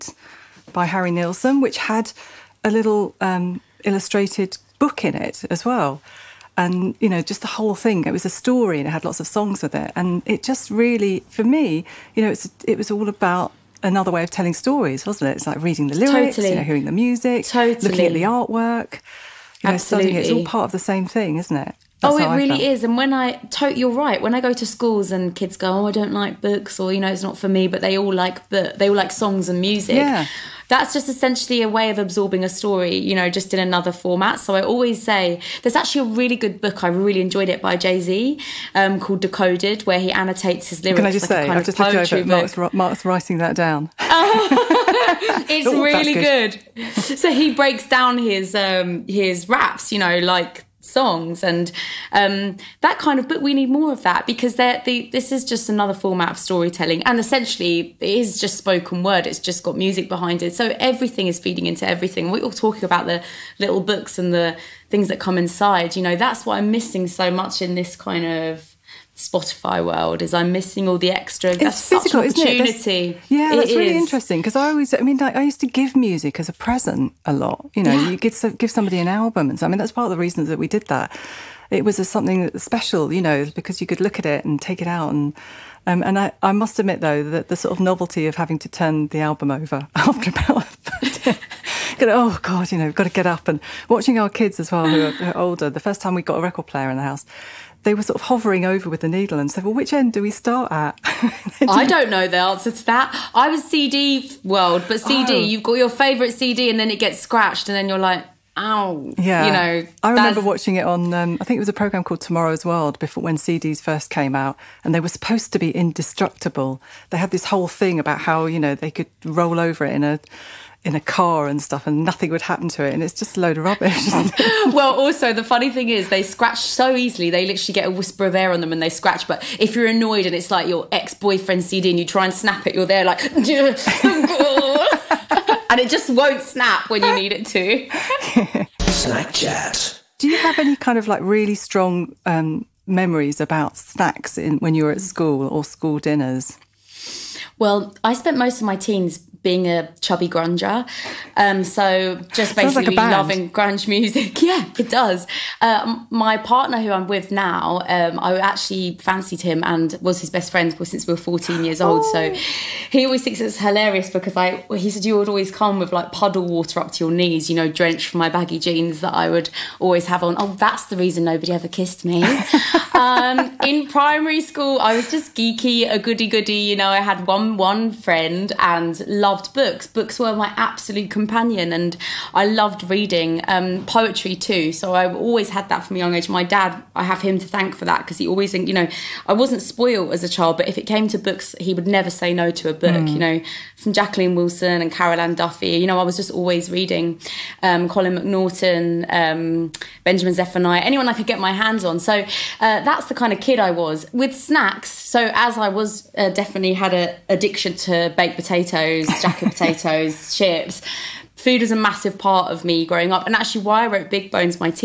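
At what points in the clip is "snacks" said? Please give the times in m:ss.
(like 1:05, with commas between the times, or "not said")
2:18, 2:23, 3:24.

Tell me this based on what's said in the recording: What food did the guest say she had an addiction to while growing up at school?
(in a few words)
Baked potatoes.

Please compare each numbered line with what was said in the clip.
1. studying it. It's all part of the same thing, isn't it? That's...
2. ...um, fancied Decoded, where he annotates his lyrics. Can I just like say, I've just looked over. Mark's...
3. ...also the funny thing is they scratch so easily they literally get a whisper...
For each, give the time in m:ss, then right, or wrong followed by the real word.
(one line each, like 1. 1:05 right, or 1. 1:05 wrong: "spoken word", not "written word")
1. 0:20 right
2. 0:38 wrong: "called", not "fancied"
3. 2:04 right.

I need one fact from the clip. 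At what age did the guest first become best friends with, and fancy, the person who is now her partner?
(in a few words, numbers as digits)
14.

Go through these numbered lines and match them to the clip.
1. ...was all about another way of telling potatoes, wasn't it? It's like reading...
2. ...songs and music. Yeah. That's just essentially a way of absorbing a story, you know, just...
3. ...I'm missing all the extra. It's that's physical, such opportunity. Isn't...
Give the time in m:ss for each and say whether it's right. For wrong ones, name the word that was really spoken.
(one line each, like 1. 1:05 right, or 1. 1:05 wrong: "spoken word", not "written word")
1. 0:12 wrong: "stories", not "potatoes"
2. 0:29 right
3. 1:10 right.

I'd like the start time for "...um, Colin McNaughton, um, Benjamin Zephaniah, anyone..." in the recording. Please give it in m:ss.
3:17.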